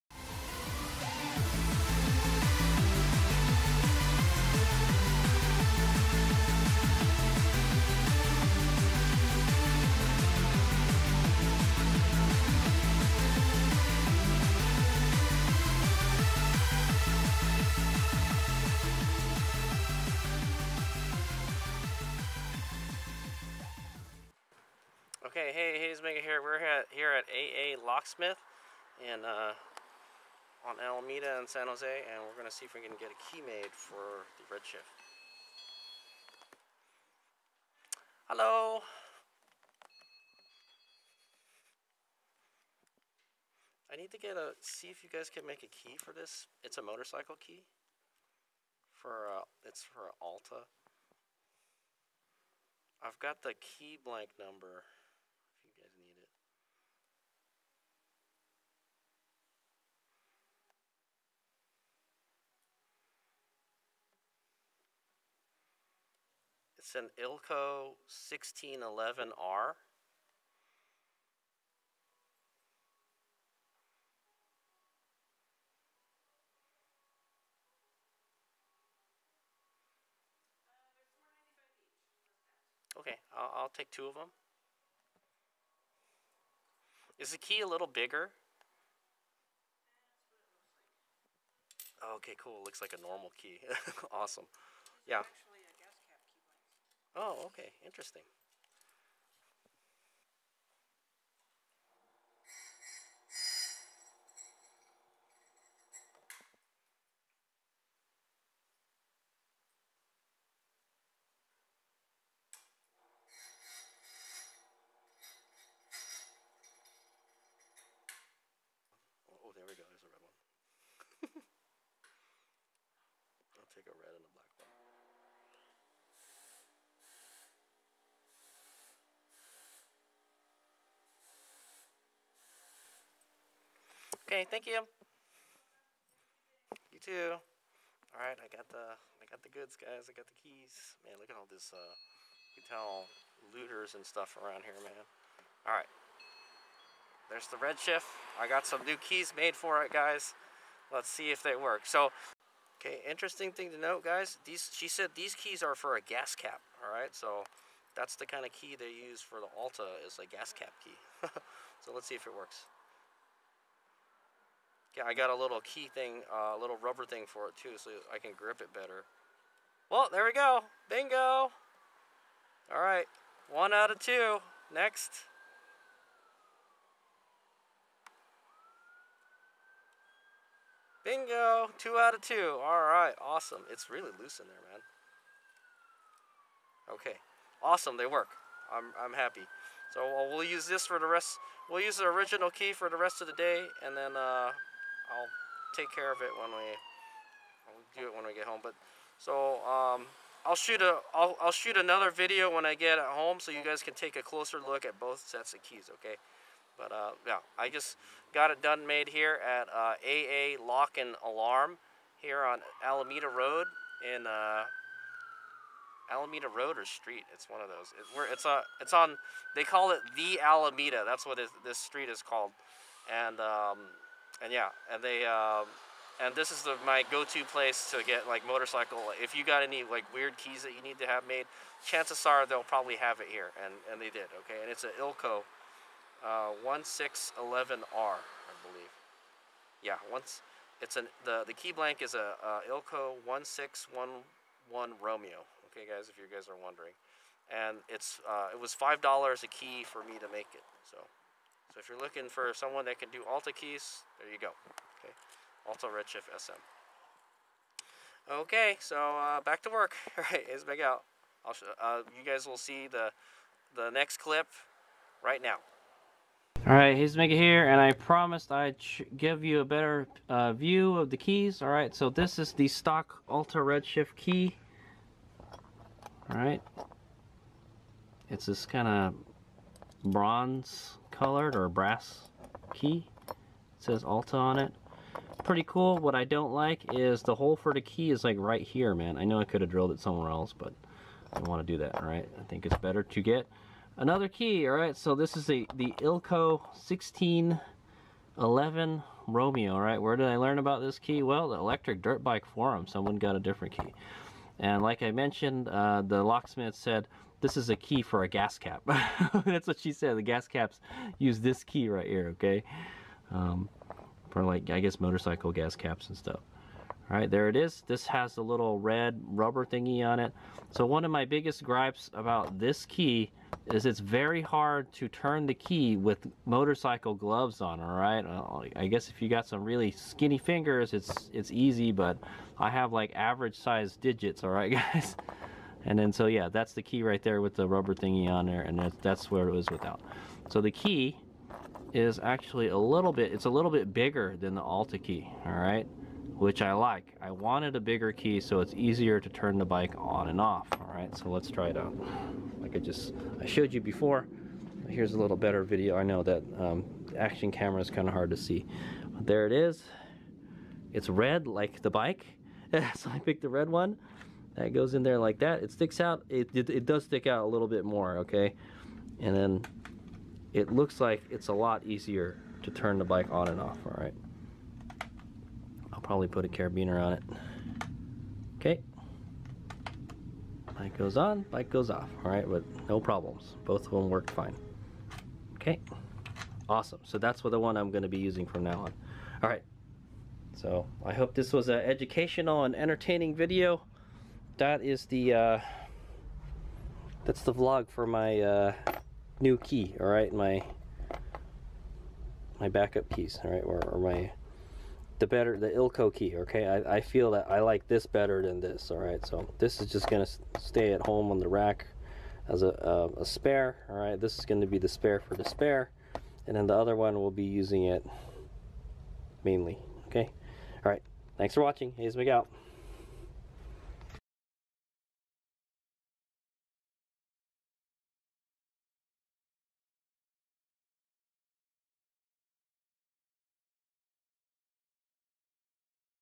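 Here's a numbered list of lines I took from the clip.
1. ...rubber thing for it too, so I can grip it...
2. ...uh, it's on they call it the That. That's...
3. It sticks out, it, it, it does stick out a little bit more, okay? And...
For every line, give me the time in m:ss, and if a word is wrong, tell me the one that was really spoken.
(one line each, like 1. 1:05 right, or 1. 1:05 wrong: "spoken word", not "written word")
1. 2:46 right
2. 3:38 wrong: "Alameda", not "That"
3. 6:05 right.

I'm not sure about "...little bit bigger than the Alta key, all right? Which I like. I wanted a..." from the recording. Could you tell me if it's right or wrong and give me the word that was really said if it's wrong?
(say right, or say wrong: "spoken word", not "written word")
right.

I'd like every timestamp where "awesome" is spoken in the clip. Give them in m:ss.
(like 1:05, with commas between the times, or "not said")
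1:34, 3:03, 3:07, 6:26.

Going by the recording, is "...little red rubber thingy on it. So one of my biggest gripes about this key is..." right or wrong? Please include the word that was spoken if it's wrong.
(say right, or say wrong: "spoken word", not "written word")
right.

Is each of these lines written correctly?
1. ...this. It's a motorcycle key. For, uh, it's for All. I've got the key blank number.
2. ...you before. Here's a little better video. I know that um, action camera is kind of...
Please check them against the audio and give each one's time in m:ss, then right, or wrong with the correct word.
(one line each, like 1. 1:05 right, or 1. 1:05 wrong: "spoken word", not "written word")
1. 0:46 wrong: "Alta", not "All"
2. 5:53 right.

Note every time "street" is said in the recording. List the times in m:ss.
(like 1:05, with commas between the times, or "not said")
3:36, 3:41.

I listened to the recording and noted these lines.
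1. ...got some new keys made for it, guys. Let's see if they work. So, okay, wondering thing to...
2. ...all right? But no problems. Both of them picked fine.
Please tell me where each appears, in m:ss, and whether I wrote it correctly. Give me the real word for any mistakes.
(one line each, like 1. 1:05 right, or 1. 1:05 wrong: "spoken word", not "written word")
1. 2:28 wrong: "interesting", not "wondering"
2. 6:22 wrong: "worked", not "picked".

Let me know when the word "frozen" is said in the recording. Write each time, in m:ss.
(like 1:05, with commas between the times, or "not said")
not said.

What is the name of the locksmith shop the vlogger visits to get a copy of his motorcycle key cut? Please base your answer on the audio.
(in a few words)
AA Locksmith.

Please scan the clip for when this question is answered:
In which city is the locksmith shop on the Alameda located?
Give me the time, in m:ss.
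0:31.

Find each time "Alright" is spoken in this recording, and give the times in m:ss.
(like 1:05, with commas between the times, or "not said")
4:26, 4:31, 4:36.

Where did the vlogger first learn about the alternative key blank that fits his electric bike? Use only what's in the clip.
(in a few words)
Electric Dirt Bike Forum.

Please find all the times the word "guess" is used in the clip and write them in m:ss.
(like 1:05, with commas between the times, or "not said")
5:14, 5:28.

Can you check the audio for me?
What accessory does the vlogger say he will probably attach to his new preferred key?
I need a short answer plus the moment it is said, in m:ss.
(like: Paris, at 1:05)
A carabiner, at 6:16.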